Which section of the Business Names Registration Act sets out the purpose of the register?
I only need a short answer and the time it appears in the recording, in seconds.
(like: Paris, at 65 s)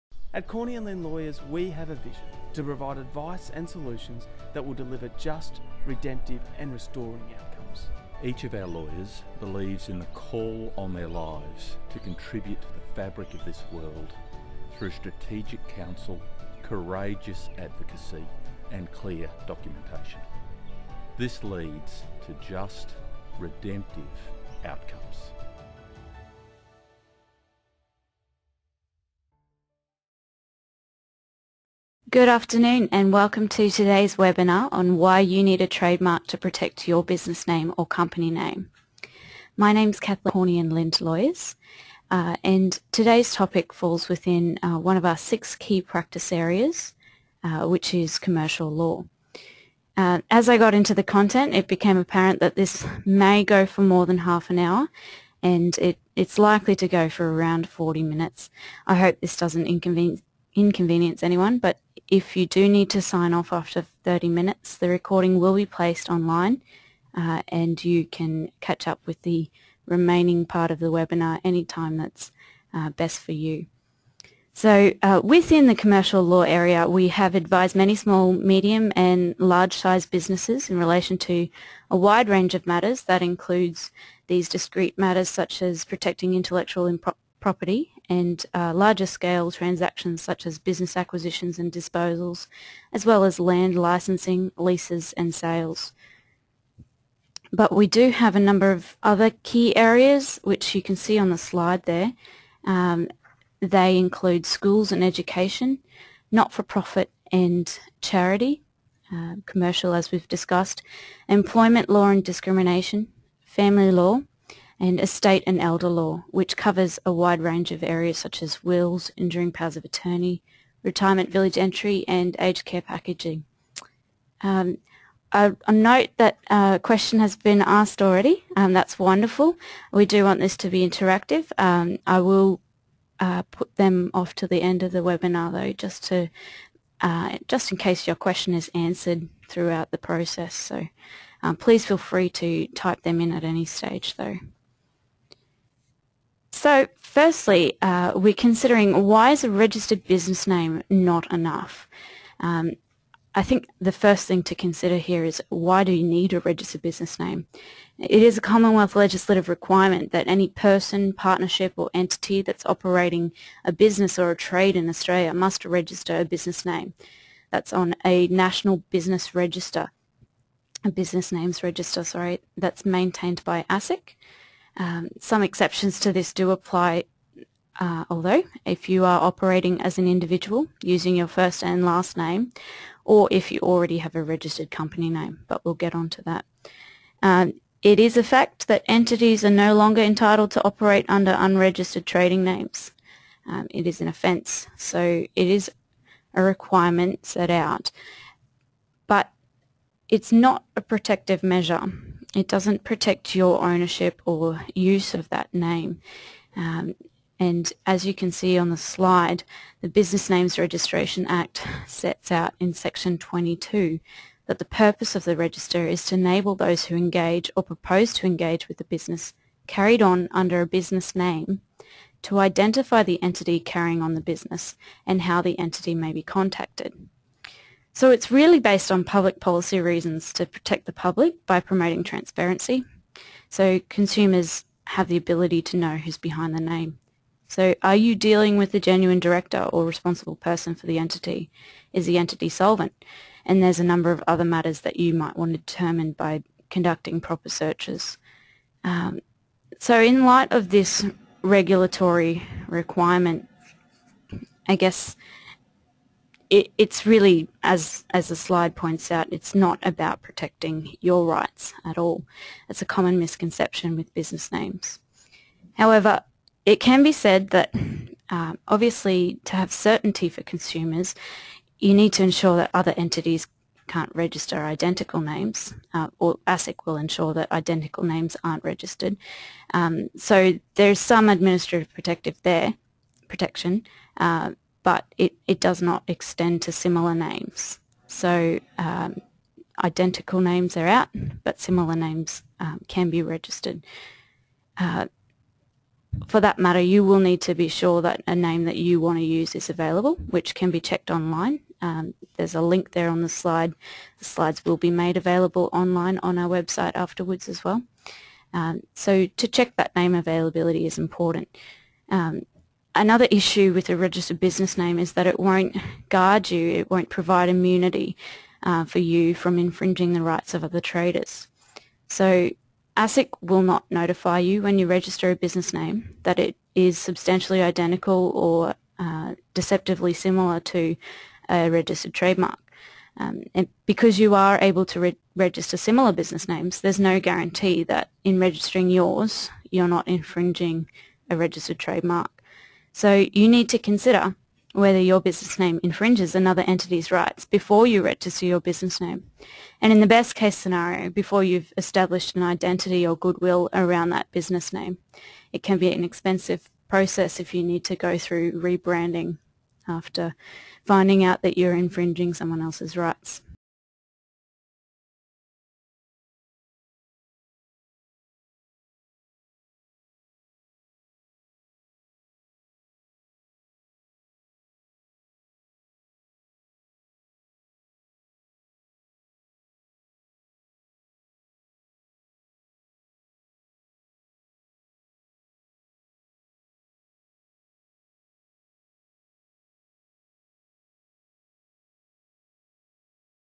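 Section 22, at 212 s.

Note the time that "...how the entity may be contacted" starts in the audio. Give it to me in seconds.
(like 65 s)
225 s.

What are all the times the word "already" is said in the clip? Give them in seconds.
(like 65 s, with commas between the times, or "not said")
128 s, 183 s.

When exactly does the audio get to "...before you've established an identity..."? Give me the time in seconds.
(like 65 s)
351 s.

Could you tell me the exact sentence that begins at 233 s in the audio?
So consumers have the ability to know who's behind the name.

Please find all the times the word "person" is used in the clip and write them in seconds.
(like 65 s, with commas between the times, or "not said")
160 s, 240 s.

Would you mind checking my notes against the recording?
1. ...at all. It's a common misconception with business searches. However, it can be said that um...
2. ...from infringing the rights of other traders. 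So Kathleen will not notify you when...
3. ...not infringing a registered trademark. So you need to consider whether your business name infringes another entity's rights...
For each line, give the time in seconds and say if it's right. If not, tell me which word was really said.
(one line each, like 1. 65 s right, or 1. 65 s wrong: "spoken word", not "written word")
1. 261 s wrong: "names", not "searches"
2. 319 s wrong: "ASIC", not "Kathleen"
3. 339 s right.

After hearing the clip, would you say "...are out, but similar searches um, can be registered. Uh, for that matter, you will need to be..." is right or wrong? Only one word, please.
wrong.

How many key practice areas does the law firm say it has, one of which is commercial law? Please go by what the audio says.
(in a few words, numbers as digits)
6.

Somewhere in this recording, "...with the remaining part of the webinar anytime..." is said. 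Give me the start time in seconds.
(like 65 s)
69 s.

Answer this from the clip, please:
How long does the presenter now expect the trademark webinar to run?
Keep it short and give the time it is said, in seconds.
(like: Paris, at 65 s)
40 minutes, at 57 s.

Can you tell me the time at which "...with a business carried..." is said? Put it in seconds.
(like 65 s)
218 s.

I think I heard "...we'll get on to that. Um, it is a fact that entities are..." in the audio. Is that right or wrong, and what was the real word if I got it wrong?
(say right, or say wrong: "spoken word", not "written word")
right.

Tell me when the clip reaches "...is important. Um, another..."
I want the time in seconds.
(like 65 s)
310 s.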